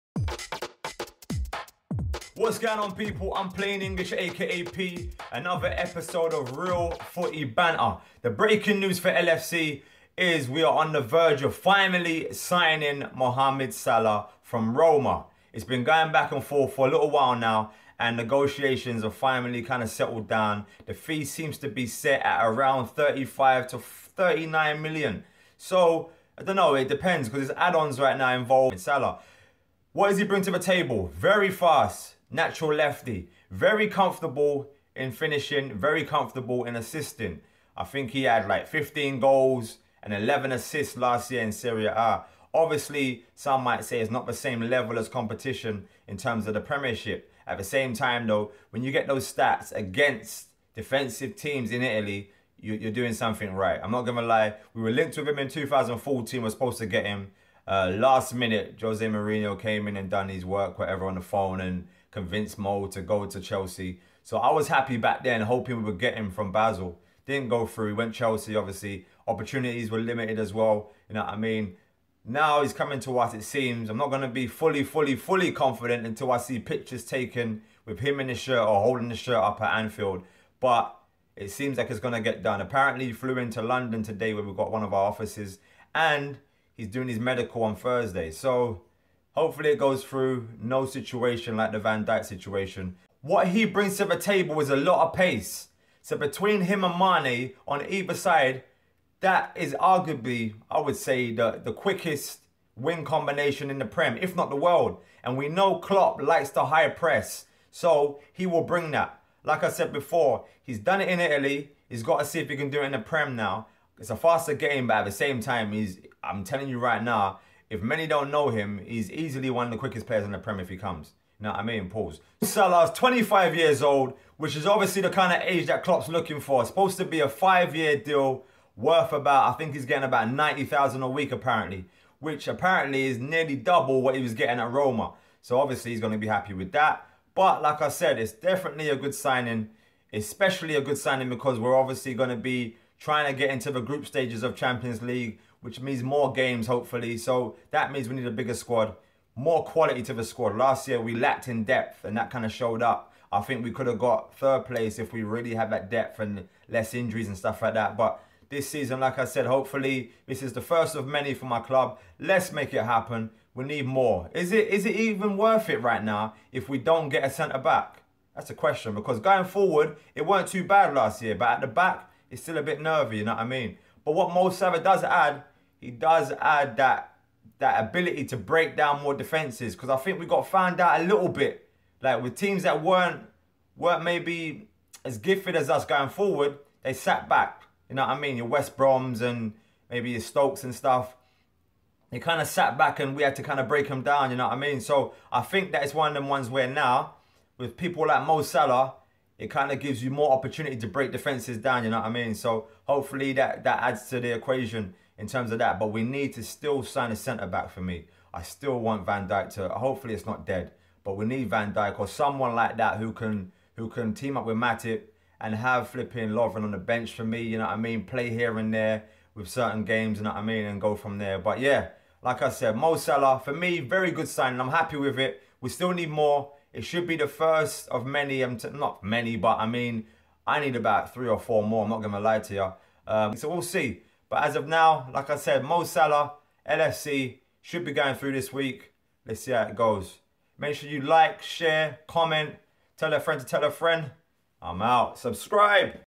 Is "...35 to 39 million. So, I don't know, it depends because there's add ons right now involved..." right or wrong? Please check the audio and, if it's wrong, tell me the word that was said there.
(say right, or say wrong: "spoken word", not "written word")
right.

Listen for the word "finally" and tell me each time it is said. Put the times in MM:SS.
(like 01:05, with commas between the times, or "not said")
00:11, 00:19.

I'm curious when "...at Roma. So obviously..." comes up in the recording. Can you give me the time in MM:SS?
02:14.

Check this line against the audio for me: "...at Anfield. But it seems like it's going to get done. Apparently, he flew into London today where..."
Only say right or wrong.
right.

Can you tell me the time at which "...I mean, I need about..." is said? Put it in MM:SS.
03:49.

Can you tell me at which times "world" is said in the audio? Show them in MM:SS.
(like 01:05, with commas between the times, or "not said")
01:44.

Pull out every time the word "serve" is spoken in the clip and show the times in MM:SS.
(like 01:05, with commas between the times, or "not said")
not said.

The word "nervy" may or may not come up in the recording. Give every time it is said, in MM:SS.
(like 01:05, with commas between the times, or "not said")
02:52.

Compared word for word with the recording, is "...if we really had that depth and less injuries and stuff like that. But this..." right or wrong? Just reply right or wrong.
right.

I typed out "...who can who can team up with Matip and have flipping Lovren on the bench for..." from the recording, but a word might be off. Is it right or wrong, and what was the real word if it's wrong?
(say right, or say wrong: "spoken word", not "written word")
right.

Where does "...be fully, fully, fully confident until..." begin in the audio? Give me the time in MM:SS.
01:14.